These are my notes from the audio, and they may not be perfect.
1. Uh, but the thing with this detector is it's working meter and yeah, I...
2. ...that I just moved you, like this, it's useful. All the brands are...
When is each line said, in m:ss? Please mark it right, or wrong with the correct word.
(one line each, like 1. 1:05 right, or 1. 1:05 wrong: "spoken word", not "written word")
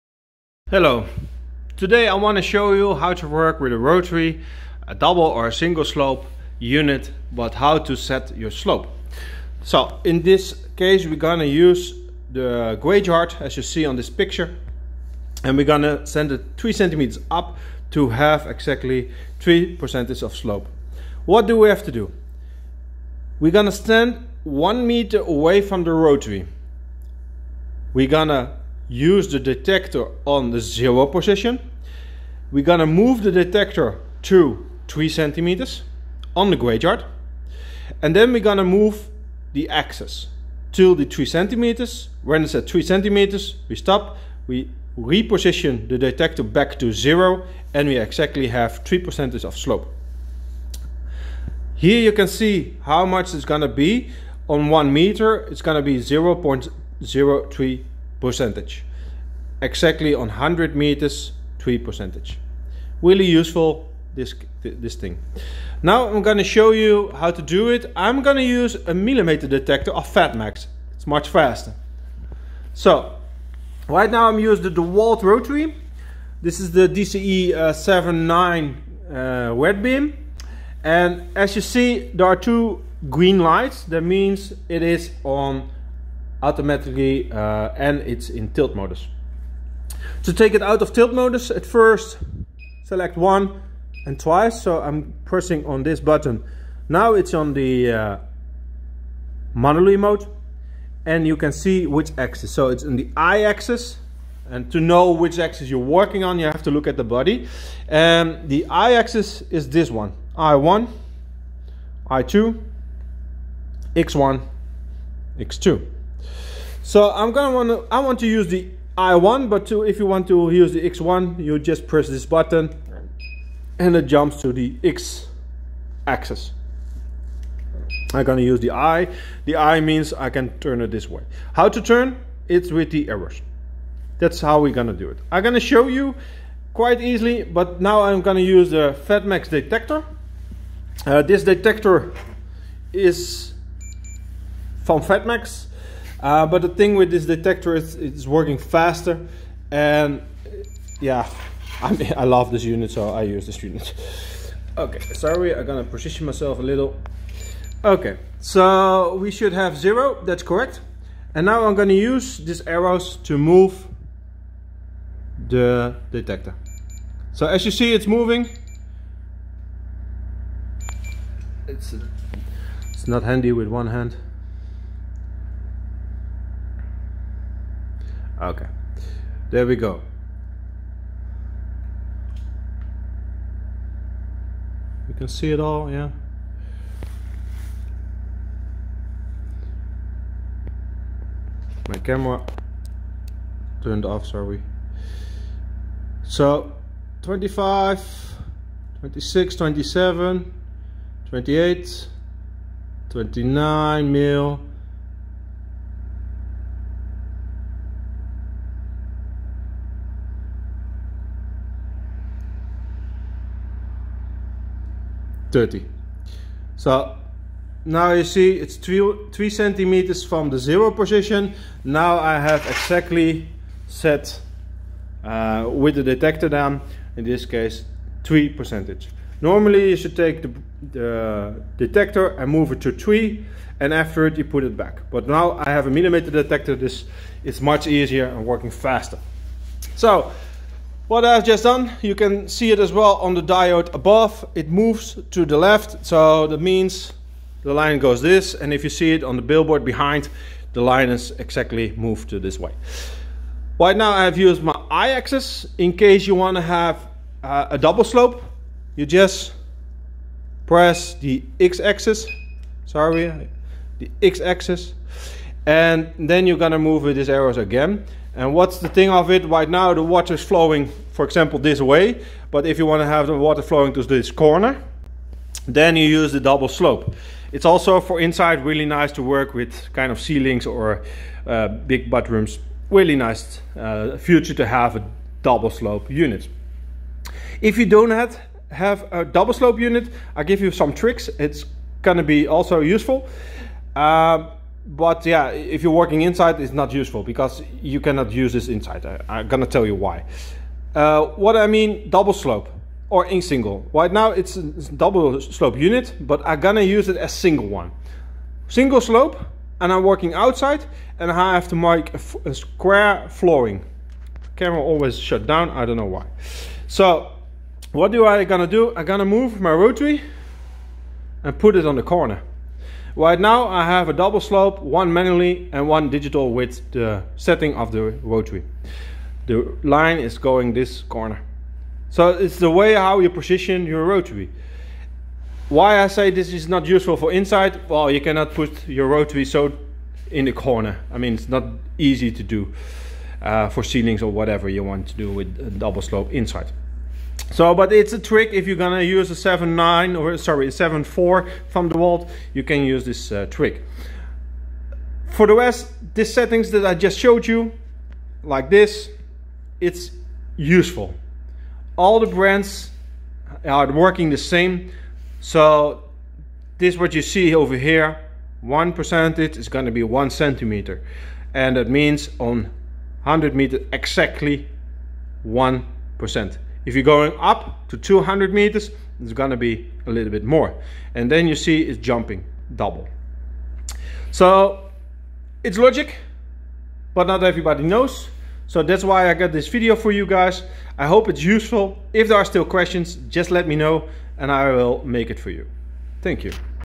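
1. 2:26 wrong: "faster", not "meter"
2. 5:56 wrong: "showed", not "moved".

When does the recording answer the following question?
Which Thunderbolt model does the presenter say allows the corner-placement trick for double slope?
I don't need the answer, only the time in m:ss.
5:50.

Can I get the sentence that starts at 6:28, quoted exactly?
So that's why I got this video for you guys.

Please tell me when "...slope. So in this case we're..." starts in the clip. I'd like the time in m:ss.
0:08.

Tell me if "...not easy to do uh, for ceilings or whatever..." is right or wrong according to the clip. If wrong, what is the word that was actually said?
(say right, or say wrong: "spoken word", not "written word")
right.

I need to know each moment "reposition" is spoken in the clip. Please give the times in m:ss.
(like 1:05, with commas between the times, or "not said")
0:44.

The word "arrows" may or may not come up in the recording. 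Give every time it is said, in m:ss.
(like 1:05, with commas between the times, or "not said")
2:13, 2:42, 4:27.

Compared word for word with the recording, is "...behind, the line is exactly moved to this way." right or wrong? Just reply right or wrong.
right.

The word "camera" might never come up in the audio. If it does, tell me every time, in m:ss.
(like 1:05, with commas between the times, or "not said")
3:11, 5:14.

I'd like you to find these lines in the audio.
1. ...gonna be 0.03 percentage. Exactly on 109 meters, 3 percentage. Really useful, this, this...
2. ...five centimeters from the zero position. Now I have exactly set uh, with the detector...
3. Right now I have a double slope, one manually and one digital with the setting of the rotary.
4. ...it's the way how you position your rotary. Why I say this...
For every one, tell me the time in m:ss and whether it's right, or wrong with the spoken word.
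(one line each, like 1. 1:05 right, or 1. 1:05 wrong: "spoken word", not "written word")
1. 0:55 wrong: "100", not "109"
2. 3:39 wrong: "three", not "five"
3. 5:23 right
4. 5:32 right.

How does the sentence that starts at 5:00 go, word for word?
Uh, what I mean, double slope or in single.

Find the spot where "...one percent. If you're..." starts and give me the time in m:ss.
6:15.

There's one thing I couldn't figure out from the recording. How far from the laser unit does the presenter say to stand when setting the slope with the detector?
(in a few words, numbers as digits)
1 meter.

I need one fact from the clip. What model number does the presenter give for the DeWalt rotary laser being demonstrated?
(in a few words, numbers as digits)
DCE 79.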